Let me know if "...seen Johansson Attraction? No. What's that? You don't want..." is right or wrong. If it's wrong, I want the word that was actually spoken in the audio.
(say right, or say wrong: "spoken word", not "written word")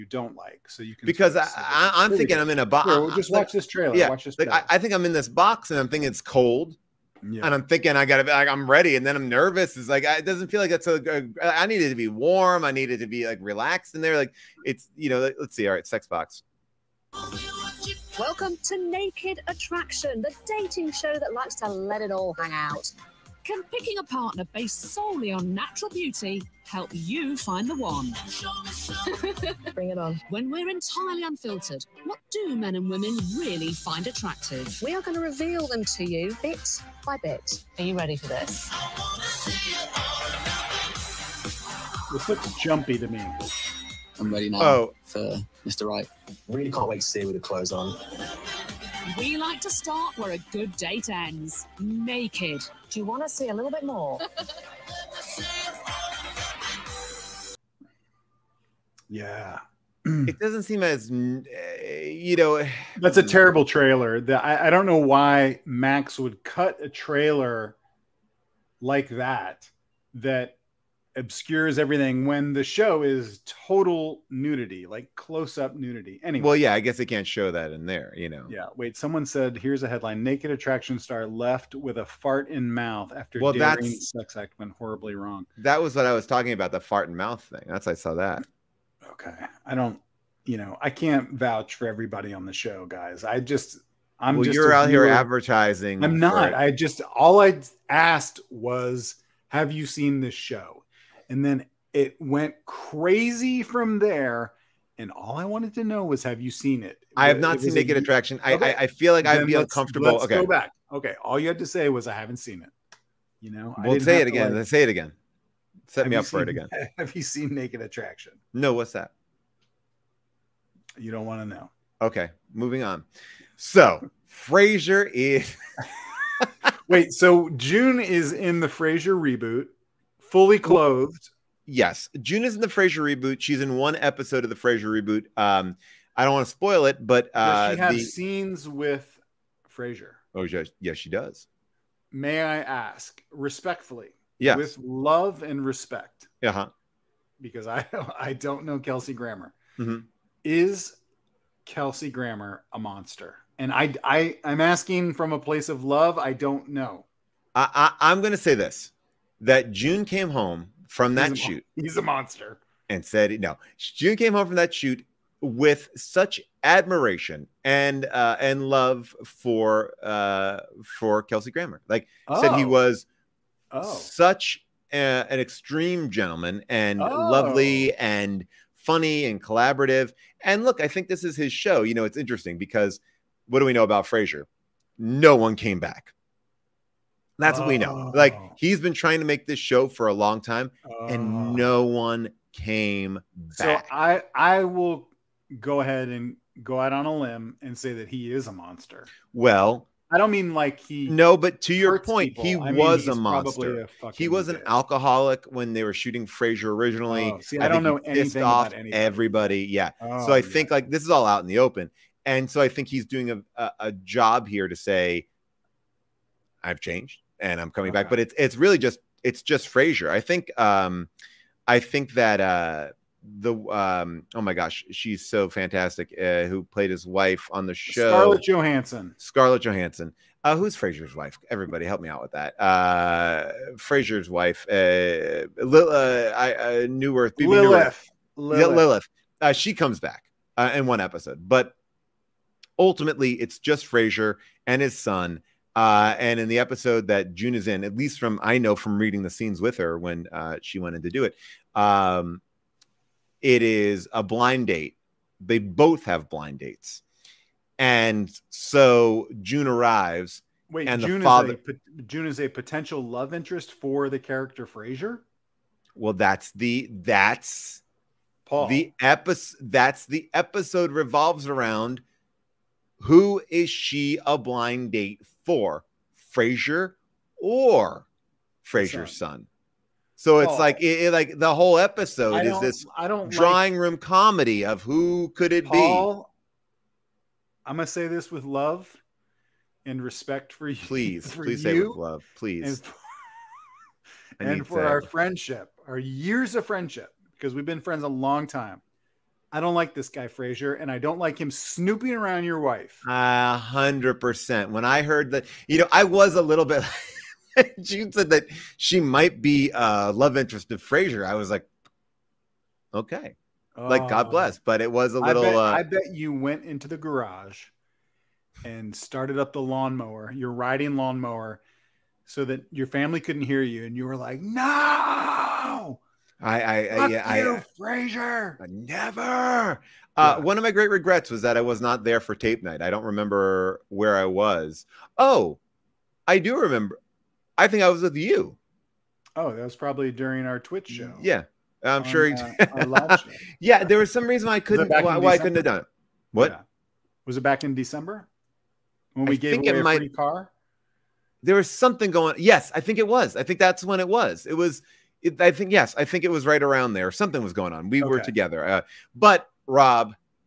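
wrong: "Naked", not "Johansson".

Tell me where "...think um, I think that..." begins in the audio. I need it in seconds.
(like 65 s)
220 s.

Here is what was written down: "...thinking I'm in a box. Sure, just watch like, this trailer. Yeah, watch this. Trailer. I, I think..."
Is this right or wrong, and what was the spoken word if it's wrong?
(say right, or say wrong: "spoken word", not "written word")
right.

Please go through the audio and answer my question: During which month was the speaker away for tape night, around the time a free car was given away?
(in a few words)
December.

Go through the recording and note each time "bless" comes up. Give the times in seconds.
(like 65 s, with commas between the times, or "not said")
314 s.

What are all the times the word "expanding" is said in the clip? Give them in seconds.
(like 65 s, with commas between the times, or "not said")
not said.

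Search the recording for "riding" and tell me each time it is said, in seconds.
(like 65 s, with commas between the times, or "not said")
320 s.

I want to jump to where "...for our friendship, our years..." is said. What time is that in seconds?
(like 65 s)
294 s.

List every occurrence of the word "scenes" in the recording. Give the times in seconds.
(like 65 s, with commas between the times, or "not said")
138 s, 249 s.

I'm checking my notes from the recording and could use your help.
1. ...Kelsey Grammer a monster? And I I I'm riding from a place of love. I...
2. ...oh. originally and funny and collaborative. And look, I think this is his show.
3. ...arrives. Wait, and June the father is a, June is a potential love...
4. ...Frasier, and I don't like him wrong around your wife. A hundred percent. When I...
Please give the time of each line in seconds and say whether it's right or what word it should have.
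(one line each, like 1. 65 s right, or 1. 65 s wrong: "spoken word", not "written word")
1. 151 s wrong: "asking", not "riding"
2. 177 s wrong: "lovely", not "originally"
3. 259 s right
4. 300 s wrong: "snooping", not "wrong".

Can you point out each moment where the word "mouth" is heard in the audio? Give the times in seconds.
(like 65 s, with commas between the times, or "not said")
82 s, 87 s.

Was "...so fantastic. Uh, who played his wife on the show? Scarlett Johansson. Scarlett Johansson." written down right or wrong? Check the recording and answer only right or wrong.
right.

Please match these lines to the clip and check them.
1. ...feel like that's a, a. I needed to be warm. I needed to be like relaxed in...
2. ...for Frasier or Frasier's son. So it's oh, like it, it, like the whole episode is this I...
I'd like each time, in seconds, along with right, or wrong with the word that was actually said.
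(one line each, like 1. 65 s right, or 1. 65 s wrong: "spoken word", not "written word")
1. 10 s right
2. 275 s right.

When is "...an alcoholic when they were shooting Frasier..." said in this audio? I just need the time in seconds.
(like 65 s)
204 s.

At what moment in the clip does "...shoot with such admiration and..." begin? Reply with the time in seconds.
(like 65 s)
164 s.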